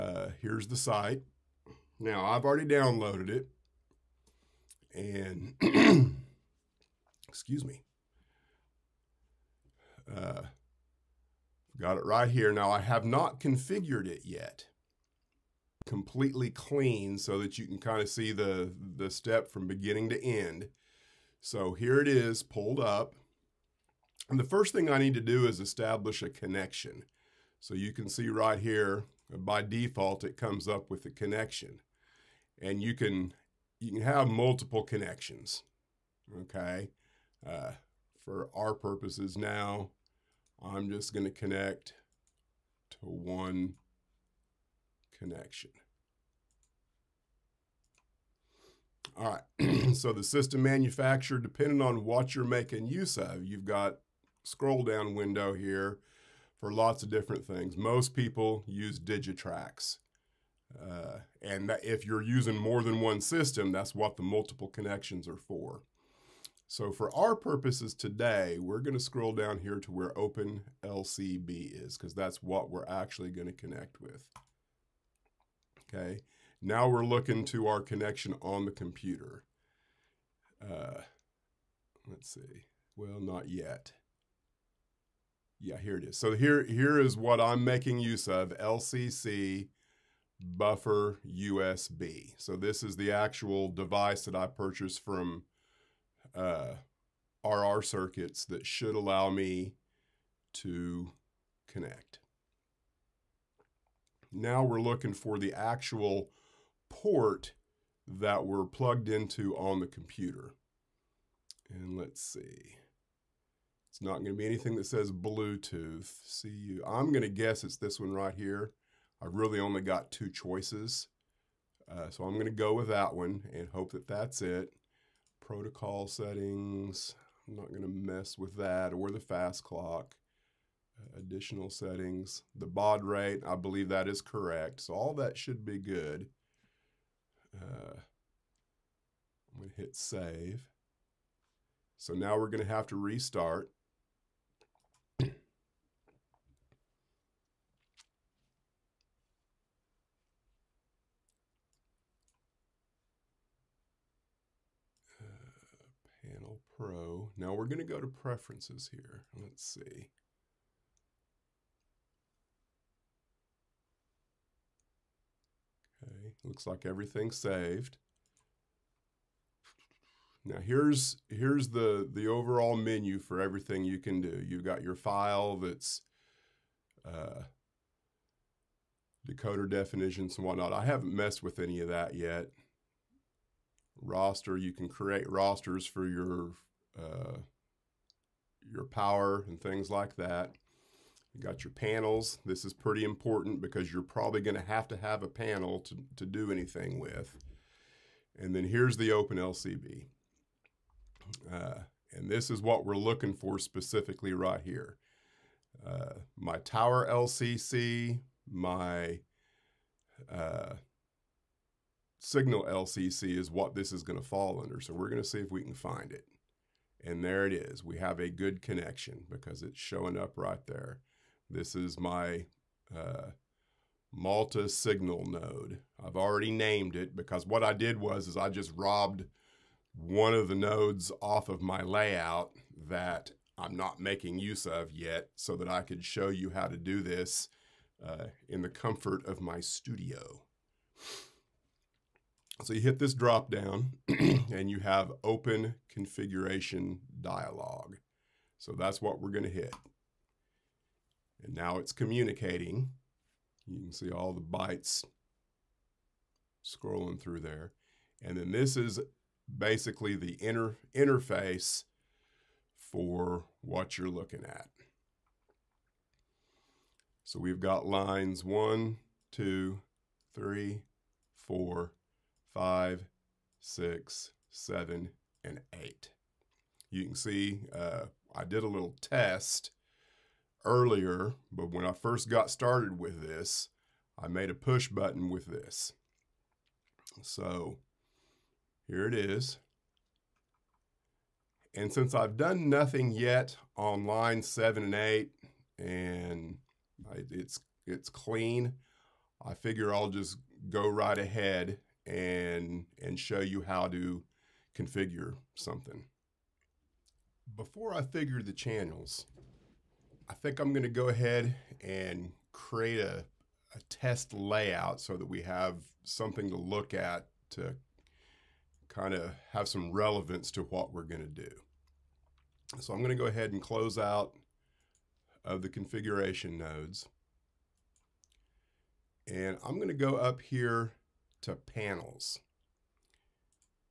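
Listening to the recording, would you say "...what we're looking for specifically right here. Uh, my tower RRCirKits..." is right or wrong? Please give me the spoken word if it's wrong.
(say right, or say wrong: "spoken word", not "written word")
wrong: "LCC", not "RRCirKits".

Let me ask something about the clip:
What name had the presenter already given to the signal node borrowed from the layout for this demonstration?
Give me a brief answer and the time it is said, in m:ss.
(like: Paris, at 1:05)
Malta signal node, at 3:44.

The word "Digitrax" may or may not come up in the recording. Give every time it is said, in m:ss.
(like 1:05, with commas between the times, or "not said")
0:58.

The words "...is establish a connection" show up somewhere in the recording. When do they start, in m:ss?
0:25.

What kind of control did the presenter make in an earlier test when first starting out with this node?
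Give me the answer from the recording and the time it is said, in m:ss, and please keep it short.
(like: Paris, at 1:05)
push button, at 4:44.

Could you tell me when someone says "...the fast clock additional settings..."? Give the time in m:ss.
2:09.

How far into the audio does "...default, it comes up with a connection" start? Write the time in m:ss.
0:29.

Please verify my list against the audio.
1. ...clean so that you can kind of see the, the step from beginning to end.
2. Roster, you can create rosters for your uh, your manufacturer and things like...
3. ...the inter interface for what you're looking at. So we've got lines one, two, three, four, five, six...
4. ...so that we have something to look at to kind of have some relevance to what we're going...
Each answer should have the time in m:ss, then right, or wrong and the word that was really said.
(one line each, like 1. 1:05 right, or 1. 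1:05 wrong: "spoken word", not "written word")
1. 0:16 right
2. 3:04 wrong: "power", not "manufacturer"
3. 4:20 right
4. 5:14 right.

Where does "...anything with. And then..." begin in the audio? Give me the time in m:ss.
3:16.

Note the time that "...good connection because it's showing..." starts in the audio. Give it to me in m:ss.
3:38.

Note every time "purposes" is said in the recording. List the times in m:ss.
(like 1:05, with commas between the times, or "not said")
0:38, 1:07.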